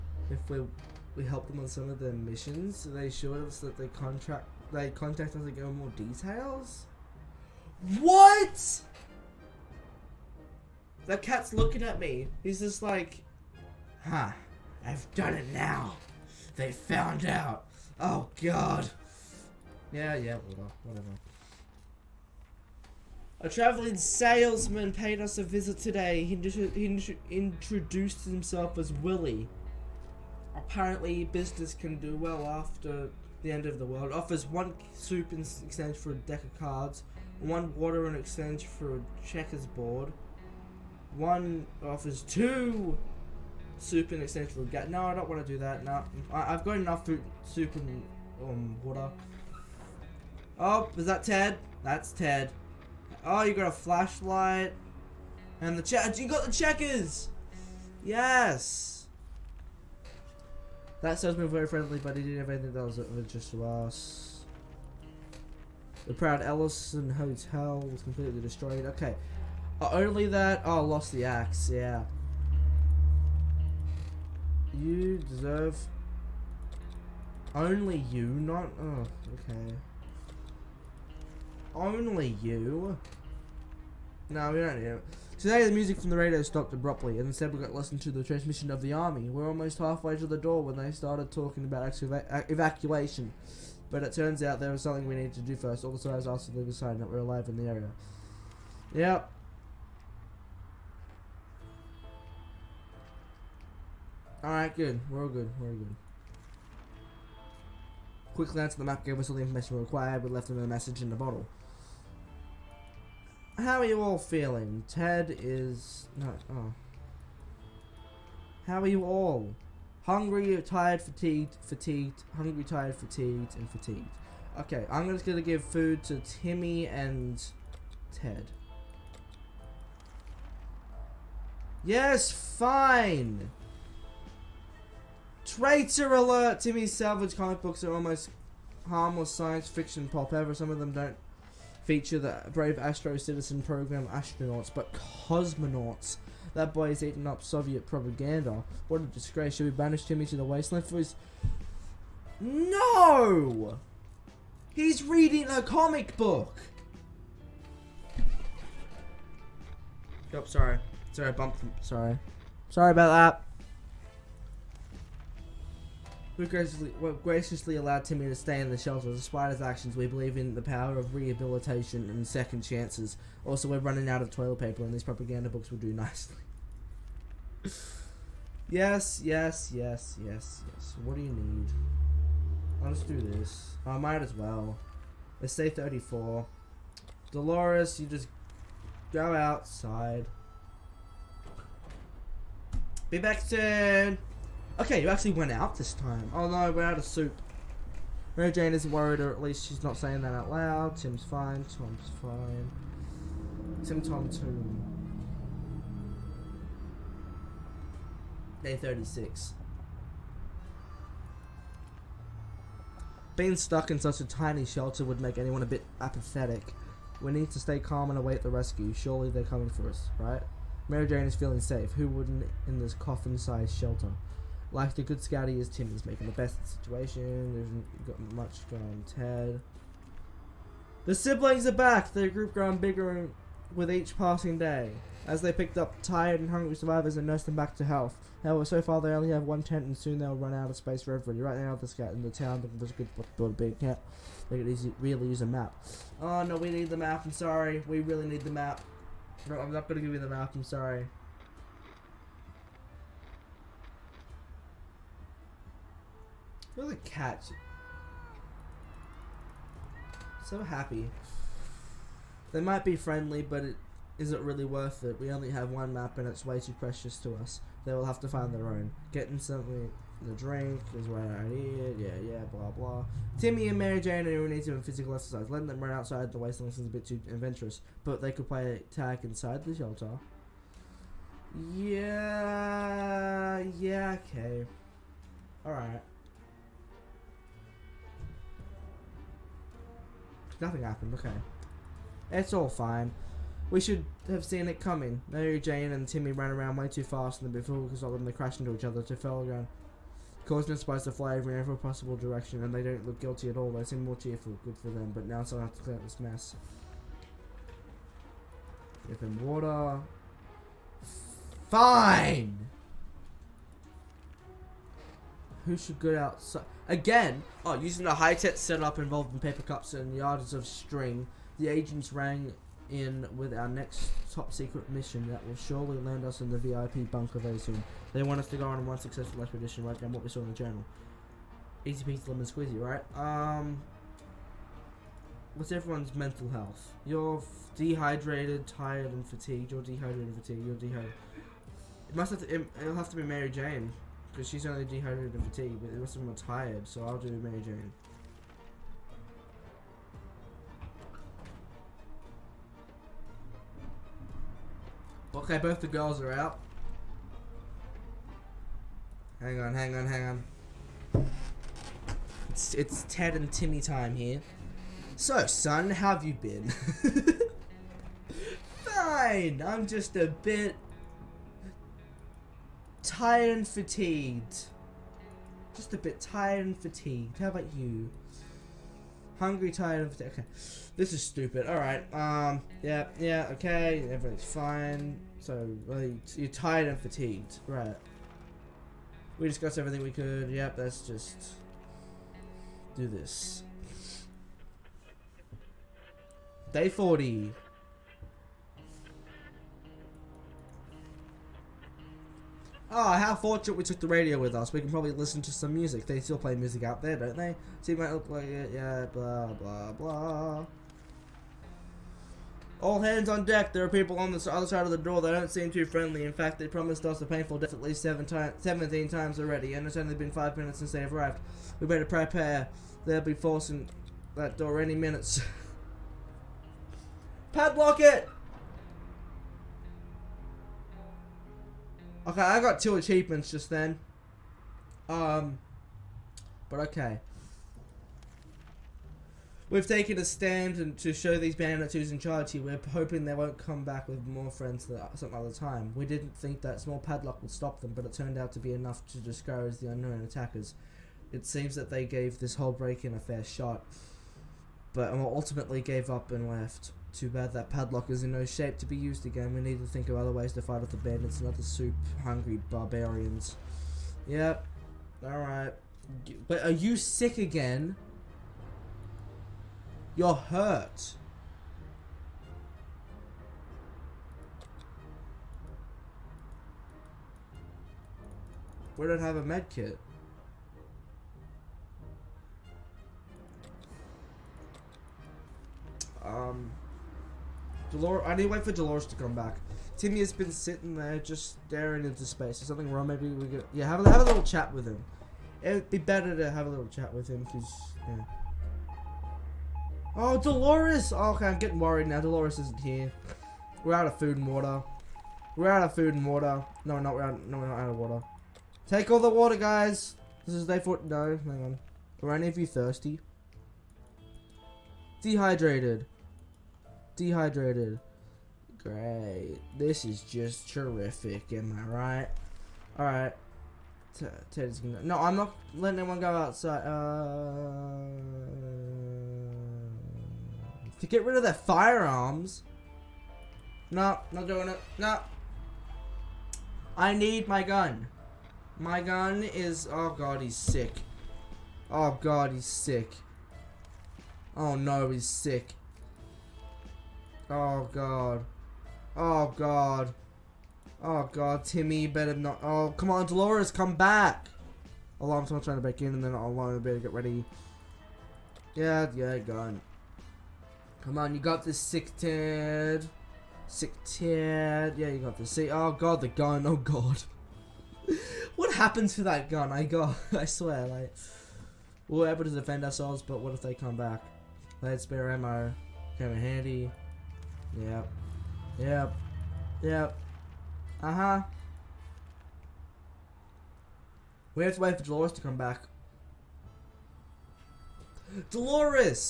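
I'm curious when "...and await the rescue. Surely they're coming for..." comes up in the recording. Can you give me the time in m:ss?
3:38.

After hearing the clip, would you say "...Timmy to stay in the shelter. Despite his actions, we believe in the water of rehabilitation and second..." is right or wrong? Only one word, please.
wrong.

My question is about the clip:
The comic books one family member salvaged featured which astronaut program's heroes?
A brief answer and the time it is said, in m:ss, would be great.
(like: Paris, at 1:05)
Astro Citizen program, at 2:22.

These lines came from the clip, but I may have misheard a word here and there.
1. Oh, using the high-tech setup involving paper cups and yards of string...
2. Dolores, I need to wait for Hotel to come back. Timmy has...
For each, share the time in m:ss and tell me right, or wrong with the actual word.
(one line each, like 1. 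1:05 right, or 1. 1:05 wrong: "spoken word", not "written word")
1. 5:17 right
2. 8:07 wrong: "Dolores", not "Hotel".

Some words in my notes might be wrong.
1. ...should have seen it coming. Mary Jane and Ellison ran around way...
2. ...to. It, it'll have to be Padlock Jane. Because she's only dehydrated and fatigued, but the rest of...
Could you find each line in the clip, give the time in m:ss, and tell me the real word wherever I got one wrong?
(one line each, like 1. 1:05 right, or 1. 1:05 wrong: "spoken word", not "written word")
1. 4:53 wrong: "Timmy", not "Ellison"
2. 5:42 wrong: "Mary", not "Padlock".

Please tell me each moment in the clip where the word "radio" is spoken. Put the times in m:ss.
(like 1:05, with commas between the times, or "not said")
1:26, 6:44.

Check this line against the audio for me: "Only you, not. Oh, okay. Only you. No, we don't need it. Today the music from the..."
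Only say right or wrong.
right.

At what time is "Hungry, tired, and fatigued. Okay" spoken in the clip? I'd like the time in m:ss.
6:19.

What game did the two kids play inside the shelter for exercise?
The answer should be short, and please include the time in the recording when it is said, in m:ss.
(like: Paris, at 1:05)
Tag, at 4:38.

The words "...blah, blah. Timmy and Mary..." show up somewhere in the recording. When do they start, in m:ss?
4:32.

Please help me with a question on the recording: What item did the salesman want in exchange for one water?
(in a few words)
A checkers board.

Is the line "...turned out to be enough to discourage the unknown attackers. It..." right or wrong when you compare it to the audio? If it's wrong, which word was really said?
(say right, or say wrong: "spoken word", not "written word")
right.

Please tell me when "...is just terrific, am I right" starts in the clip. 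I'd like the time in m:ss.
8:40.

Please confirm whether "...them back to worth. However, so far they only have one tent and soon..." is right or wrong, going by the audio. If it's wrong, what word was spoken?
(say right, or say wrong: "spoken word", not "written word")
wrong: "health", not "worth".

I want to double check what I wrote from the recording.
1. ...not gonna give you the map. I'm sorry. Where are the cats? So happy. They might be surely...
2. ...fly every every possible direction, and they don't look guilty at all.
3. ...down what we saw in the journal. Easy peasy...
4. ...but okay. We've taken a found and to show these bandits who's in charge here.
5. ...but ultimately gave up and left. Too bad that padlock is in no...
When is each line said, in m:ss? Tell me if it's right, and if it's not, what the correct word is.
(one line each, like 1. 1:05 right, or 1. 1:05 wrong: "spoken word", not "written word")
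1. 4:09 wrong: "friendly", not "surely"
2. 5:01 right
3. 5:29 right
4. 7:16 wrong: "stand", not "found"
5. 7:34 right.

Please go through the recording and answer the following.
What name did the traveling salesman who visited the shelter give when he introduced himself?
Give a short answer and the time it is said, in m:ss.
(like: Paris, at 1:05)
Willie, at 0:28.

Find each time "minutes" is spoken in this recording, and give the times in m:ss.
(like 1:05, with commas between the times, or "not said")
7:00, 7:04.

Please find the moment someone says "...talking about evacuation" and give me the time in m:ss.
1:31.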